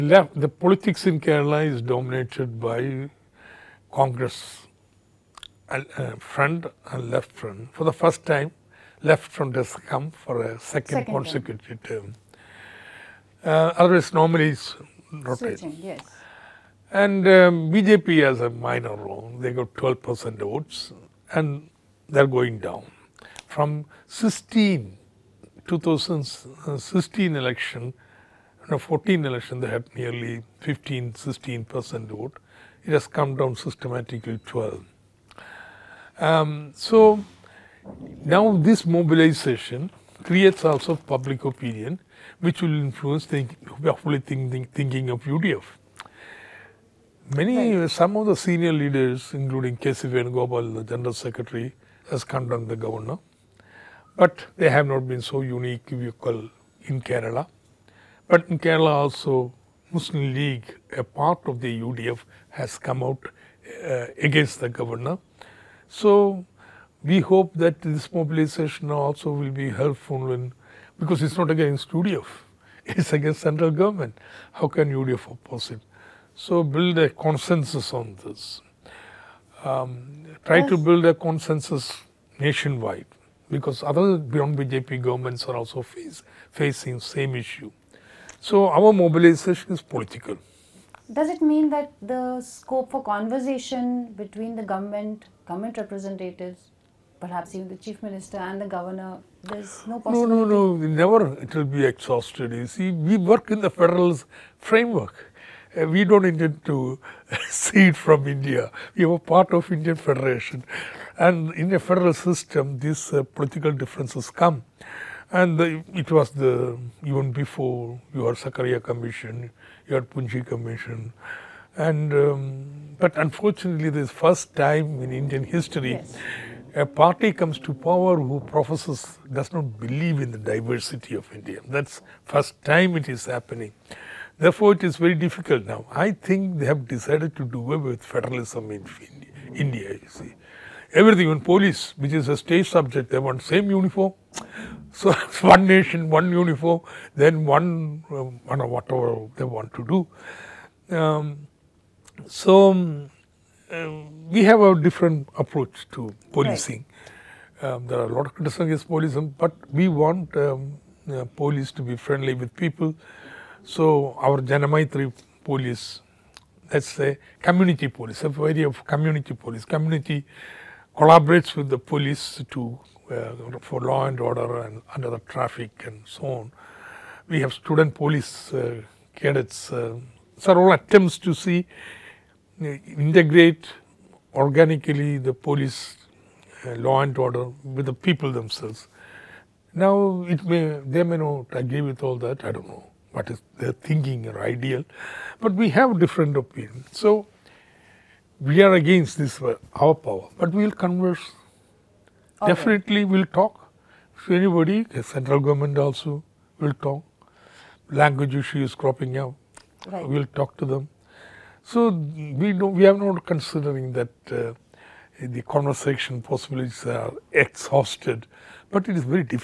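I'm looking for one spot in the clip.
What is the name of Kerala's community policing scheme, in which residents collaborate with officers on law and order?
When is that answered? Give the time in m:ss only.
2:44.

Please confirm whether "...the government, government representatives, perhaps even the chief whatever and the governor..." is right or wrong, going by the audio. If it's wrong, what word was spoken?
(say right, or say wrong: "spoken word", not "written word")
wrong: "minister", not "whatever".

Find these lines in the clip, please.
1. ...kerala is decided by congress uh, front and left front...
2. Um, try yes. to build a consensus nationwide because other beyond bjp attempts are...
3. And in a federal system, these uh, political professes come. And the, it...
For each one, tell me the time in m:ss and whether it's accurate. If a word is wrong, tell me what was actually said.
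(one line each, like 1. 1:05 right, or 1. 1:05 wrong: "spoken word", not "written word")
1. 0:01 wrong: "dominated", not "decided"
2. 1:19 wrong: "governments", not "attempts"
3. 1:51 wrong: "differences", not "professes".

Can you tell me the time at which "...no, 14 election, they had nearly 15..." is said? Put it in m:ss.
0:28.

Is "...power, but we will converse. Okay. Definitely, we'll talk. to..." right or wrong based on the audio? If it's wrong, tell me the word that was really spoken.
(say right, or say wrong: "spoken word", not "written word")
right.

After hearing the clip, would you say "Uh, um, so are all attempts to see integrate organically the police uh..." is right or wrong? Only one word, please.
right.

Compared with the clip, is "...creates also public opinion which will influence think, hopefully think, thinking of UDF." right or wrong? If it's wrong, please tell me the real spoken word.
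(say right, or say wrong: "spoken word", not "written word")
right.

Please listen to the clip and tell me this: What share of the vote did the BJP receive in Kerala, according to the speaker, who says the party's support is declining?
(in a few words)
12 percent.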